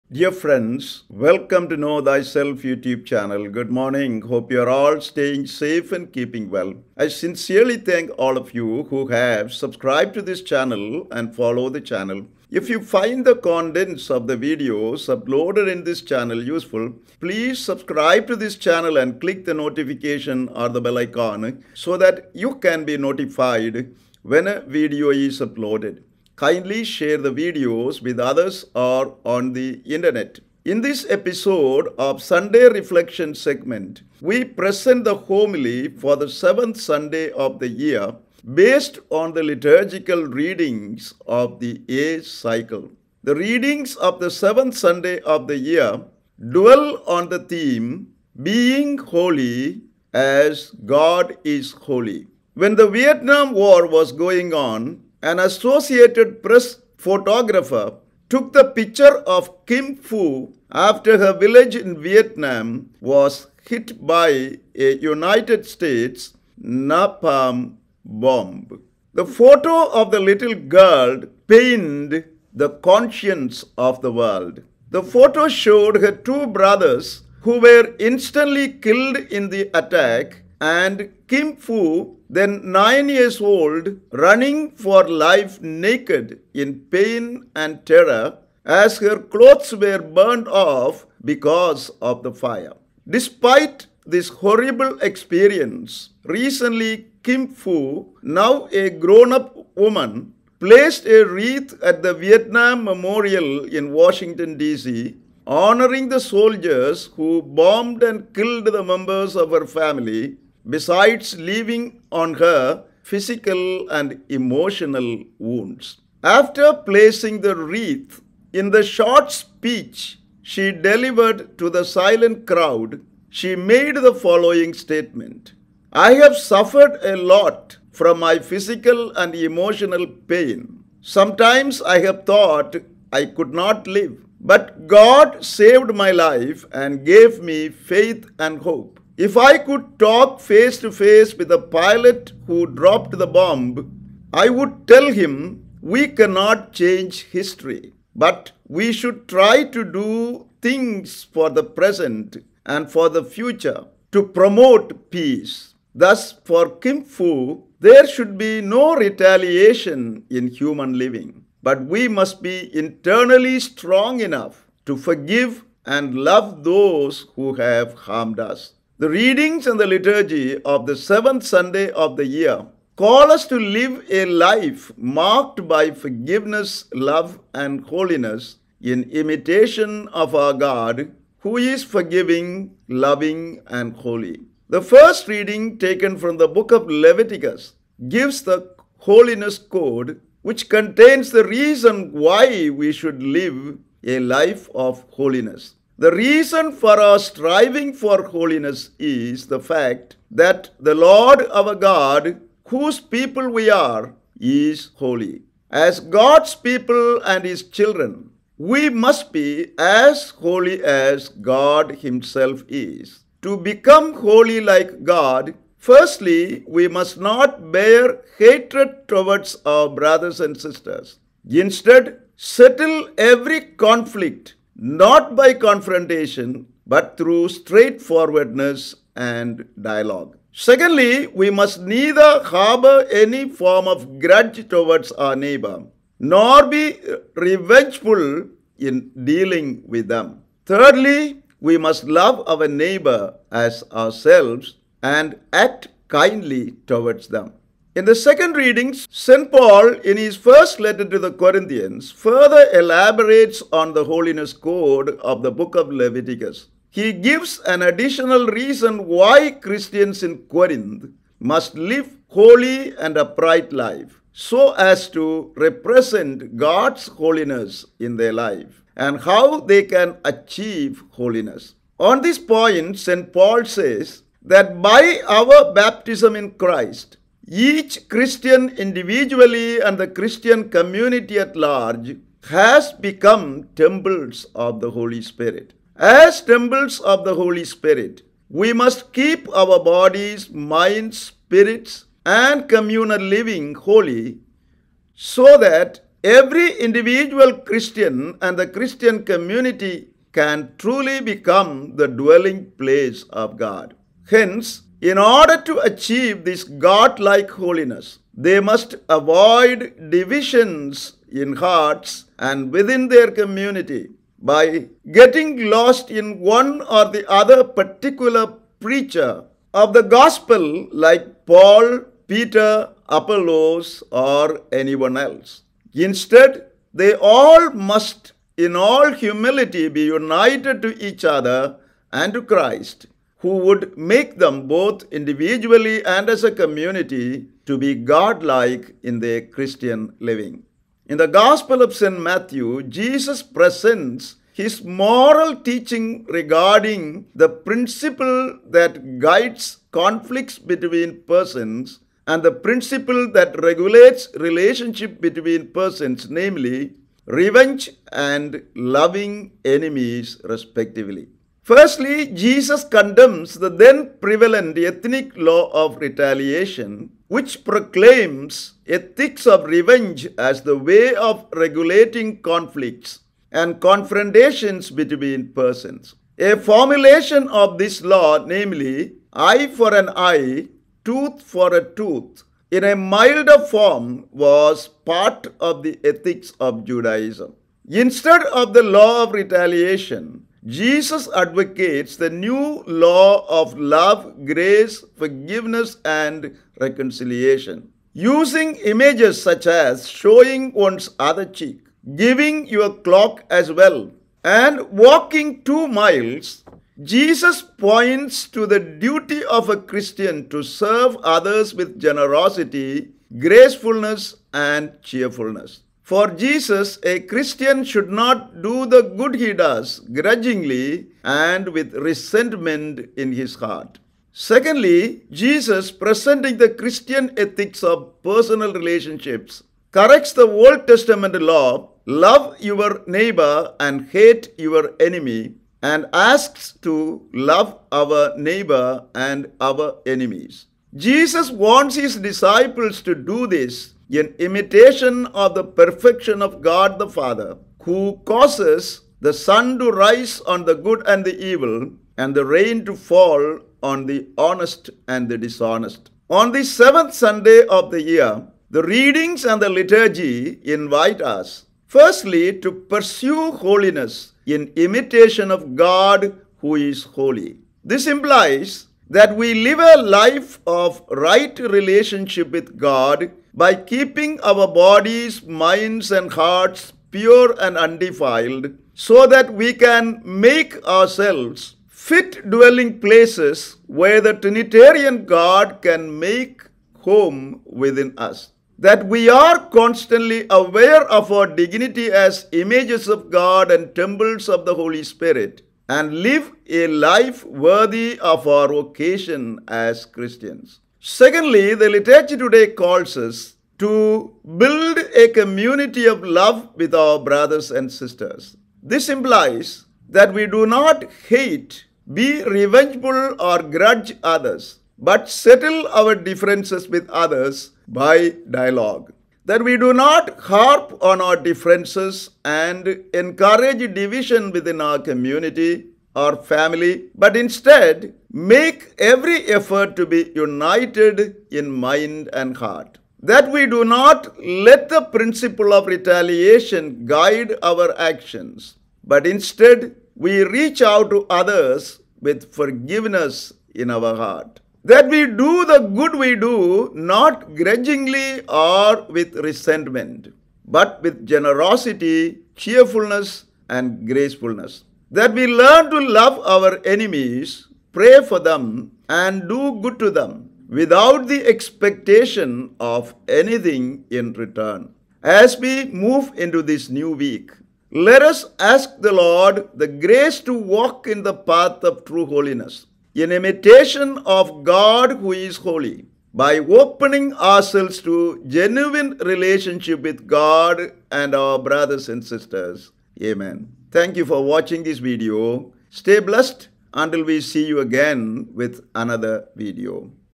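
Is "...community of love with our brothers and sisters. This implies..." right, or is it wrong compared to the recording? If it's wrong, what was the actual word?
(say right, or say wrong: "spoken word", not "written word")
right.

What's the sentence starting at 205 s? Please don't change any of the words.
As God's people and His children, we must be as holy as God Himself is.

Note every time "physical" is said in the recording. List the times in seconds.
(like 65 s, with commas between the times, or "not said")
113 s, 128 s.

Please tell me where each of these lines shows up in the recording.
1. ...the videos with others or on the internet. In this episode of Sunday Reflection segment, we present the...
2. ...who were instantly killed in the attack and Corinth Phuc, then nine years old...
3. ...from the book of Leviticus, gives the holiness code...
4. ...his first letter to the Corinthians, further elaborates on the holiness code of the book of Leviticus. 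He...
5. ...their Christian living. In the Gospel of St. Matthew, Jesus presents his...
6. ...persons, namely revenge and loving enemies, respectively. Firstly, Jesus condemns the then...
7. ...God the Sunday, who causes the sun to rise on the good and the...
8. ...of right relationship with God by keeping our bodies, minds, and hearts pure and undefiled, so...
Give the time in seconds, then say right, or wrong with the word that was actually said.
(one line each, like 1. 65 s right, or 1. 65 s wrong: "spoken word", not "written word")
1. 27 s right
2. 77 s wrong: "Kim", not "Corinth"
3. 186 s right
4. 250 s right
5. 339 s right
6. 355 s right
7. 446 s wrong: "Father", not "Sunday"
8. 470 s right.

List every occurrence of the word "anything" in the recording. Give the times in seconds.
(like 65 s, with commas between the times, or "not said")
563 s.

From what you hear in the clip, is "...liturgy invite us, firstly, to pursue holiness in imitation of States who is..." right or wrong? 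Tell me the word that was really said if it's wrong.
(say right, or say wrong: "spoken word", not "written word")
wrong: "God", not "States".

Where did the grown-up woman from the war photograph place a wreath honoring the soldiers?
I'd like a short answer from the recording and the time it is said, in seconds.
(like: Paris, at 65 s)
Vietnam Memorial in Washington, D.C., at 102 s.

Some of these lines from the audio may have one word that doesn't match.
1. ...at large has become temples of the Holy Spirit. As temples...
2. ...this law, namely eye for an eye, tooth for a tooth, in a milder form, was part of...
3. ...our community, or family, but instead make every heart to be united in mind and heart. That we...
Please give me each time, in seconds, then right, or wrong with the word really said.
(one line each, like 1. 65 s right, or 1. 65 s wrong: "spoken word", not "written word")
1. 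281 s right
2. 377 s right
3. 524 s wrong: "effort", not "heart".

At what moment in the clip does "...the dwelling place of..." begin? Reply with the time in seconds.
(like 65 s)
301 s.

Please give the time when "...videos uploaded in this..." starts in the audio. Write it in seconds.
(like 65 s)
14 s.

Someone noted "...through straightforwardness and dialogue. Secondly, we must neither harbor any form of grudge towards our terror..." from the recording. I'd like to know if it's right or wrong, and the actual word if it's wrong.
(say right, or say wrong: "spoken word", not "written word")
wrong: "neighbor", not "terror".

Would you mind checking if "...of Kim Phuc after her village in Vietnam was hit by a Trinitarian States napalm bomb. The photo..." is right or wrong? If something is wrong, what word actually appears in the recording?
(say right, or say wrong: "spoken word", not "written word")
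wrong: "United", not "Trinitarian".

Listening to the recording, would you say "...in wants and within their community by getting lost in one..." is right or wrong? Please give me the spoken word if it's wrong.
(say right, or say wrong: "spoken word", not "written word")
wrong: "hearts", not "wants".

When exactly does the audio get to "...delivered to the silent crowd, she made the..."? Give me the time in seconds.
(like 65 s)
120 s.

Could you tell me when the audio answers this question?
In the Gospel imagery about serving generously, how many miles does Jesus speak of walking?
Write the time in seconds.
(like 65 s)
405 s.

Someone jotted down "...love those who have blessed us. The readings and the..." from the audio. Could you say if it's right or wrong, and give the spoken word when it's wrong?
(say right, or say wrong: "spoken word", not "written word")
wrong: "harmed", not "blessed".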